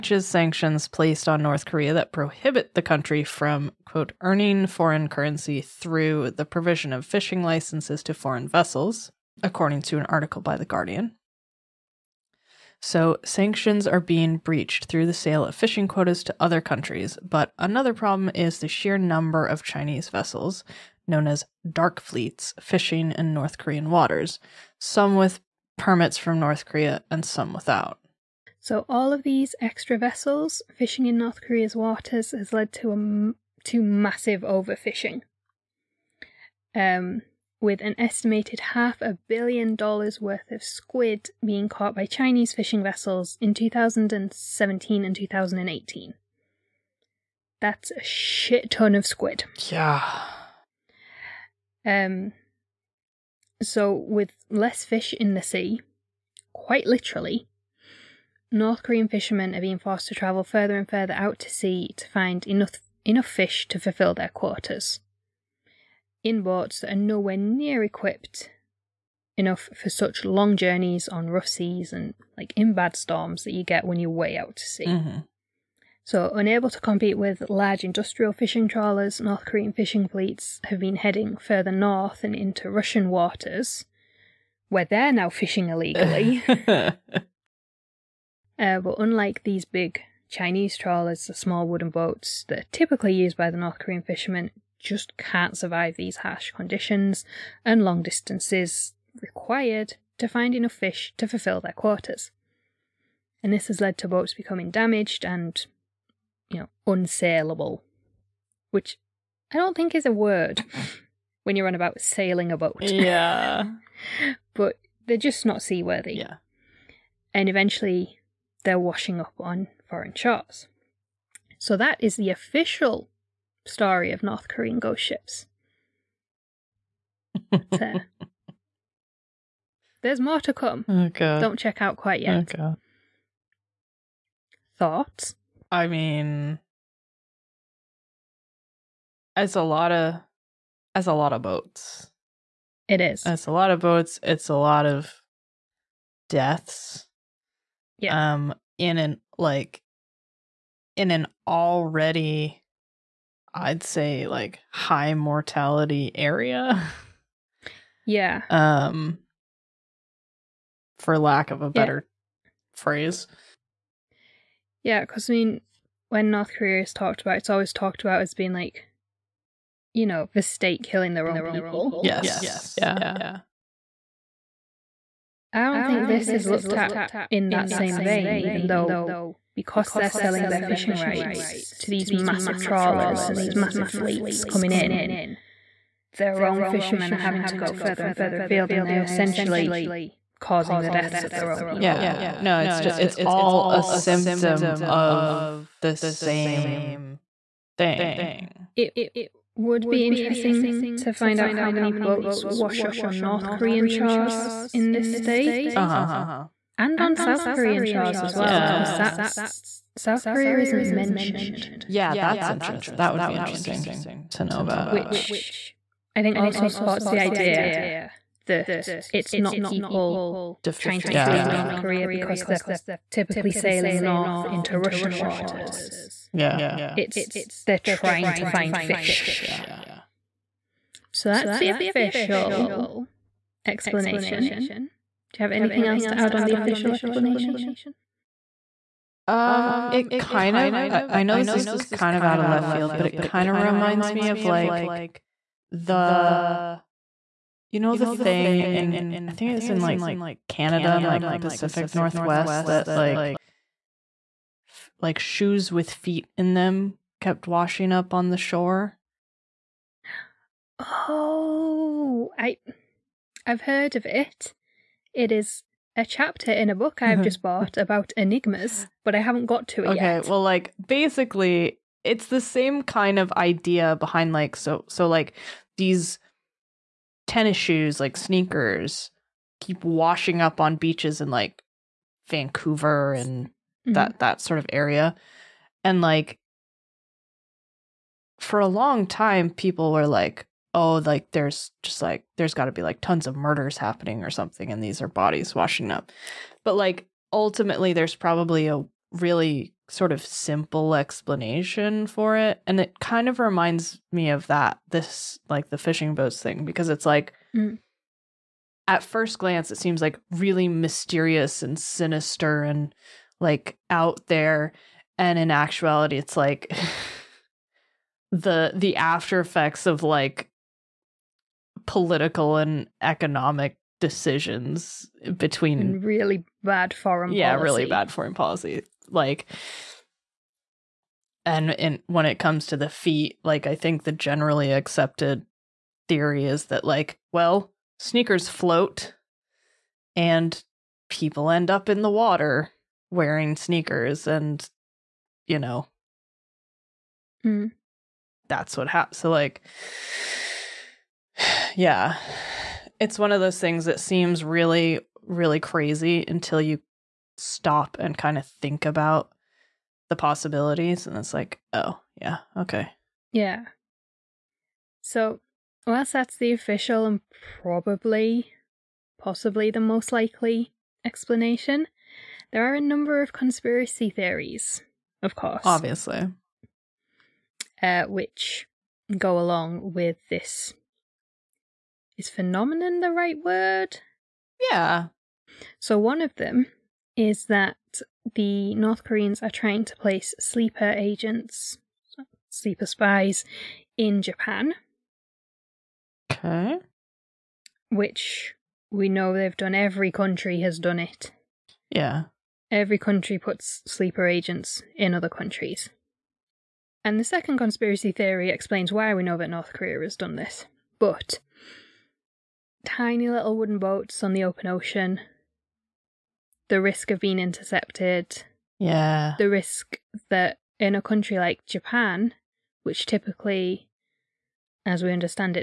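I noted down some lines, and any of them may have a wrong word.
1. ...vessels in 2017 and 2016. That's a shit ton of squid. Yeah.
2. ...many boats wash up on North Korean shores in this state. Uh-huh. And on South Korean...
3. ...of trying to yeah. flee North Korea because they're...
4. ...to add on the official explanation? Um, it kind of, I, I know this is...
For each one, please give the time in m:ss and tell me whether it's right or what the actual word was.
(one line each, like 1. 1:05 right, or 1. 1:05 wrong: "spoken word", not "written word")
1. 0:42 wrong: "2018", not "2016"
2. 3:21 right
3. 3:40 right
4. 3:56 right.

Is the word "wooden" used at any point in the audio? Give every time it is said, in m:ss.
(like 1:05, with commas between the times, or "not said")
1:31, 6:53.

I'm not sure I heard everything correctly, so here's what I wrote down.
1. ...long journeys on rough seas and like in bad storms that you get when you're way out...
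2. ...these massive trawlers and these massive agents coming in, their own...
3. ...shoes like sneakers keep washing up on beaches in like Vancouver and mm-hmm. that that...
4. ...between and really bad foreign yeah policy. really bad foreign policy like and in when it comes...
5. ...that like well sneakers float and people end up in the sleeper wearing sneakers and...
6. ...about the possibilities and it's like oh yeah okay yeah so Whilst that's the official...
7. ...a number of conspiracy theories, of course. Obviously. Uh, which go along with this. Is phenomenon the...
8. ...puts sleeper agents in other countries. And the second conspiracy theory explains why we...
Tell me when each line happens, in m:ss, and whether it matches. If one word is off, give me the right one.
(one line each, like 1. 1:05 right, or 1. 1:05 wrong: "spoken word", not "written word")
1. 1:10 right
2. 3:01 wrong: "fleets", not "agents"
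3. 4:37 right
4. 5:25 right
5. 5:36 wrong: "water", not "sleeper"
6. 5:58 right
7. 6:12 right
8. 6:43 right.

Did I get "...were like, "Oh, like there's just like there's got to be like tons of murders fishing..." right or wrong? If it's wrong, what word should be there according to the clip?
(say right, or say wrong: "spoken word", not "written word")
wrong: "happening", not "fishing".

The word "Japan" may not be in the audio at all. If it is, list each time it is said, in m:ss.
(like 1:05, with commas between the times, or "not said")
6:34, 7:01.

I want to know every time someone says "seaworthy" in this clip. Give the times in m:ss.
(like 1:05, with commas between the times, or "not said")
1:55.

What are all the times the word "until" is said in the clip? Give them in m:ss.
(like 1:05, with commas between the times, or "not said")
5:56.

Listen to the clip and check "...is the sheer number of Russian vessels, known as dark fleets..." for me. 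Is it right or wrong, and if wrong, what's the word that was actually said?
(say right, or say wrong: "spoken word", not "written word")
wrong: "Chinese", not "Russian".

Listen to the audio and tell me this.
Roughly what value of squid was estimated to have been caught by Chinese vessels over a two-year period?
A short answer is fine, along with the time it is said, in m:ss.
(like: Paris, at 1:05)
half a billion dollars, at 0:38.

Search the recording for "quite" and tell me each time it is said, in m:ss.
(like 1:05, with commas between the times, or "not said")
0:56, 2:11.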